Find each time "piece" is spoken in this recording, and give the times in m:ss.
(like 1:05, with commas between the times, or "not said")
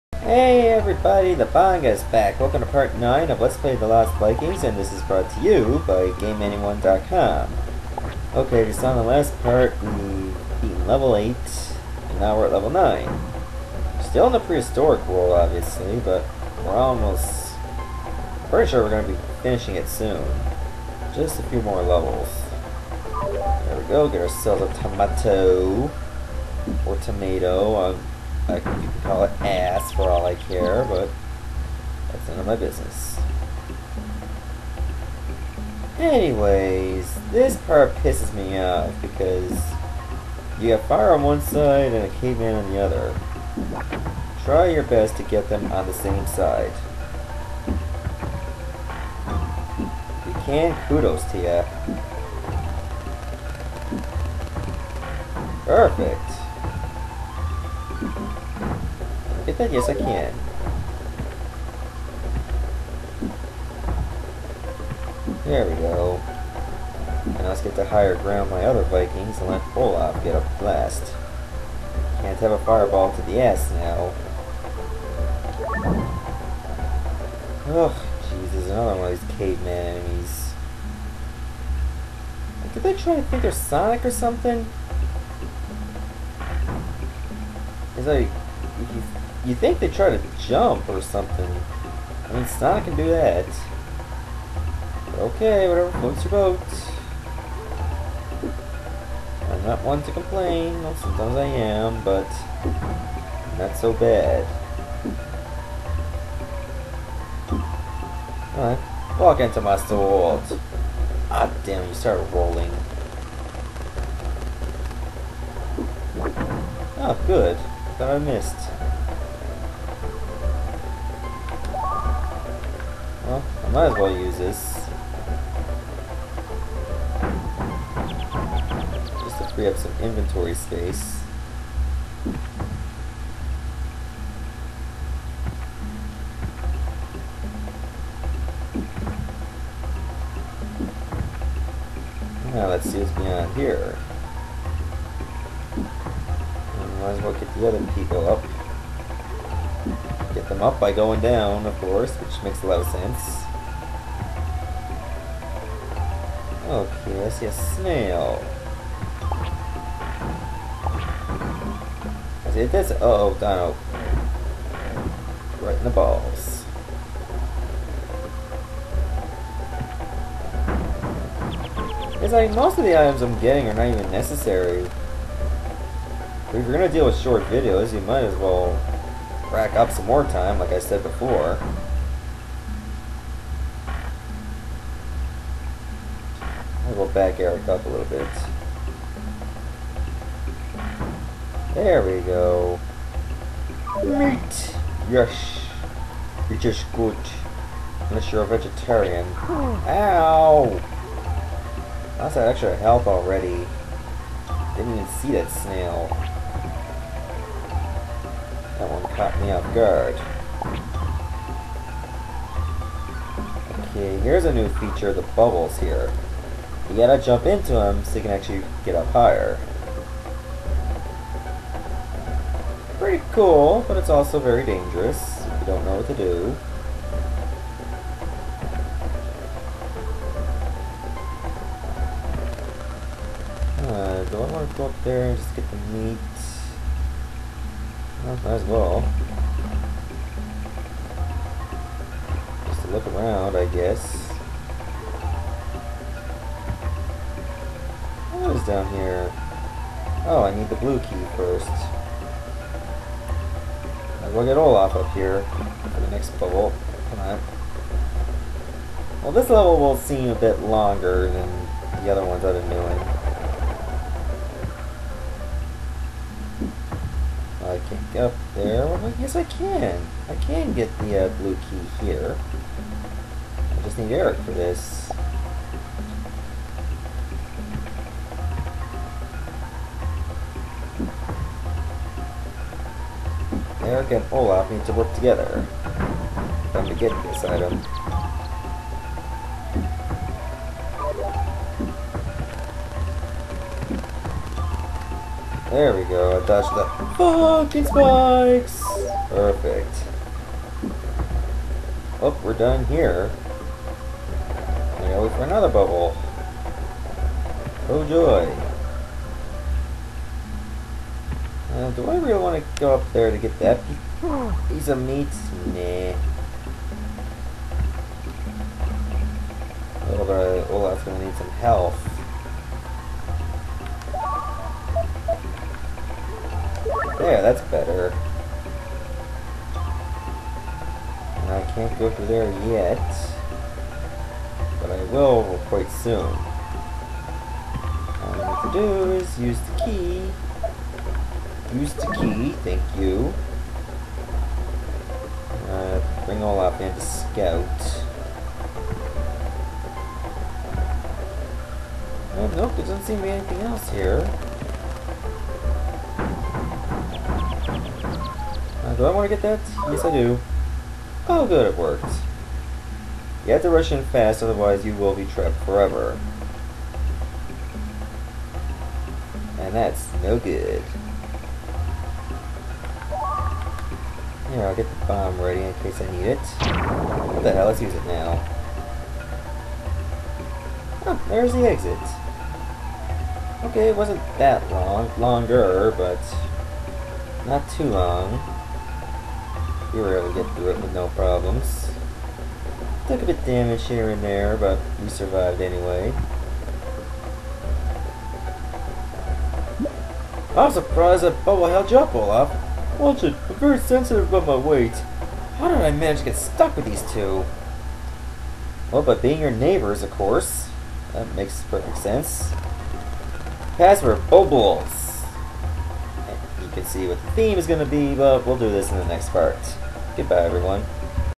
5:14.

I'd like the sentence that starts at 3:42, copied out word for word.
Pretty cool, but it's also very dangerous if you don't know what to do.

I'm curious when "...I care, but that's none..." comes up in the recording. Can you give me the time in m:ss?
0:30.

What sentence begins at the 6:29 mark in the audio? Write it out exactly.
We were able to get through it with no problems.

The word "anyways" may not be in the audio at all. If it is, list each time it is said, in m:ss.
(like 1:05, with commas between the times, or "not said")
0:35, 6:35.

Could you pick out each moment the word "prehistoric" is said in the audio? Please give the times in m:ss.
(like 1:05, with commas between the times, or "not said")
0:14.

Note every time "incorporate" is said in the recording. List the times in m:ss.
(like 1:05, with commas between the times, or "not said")
not said.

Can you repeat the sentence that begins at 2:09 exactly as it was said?
Just to free up some inventory space.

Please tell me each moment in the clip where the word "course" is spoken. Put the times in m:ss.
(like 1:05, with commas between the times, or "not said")
2:31, 6:50.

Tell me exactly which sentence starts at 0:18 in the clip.
Pretty sure we're going to be finishing it soon.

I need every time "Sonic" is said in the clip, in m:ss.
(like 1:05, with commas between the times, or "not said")
1:23, 1:32.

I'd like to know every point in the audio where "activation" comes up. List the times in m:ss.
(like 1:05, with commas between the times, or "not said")
not said.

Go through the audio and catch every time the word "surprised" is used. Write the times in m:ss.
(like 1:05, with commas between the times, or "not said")
6:40.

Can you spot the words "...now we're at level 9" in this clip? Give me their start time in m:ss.
0:12.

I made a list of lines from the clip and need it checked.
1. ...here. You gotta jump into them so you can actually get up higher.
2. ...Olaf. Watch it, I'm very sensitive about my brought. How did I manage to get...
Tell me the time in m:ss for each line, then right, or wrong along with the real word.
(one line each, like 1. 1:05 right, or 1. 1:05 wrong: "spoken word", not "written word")
1. 3:35 right
2. 6:42 wrong: "weight", not "brought".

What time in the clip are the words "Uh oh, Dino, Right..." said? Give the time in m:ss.
2:42.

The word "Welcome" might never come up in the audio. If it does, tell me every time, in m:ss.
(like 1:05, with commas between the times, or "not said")
0:02.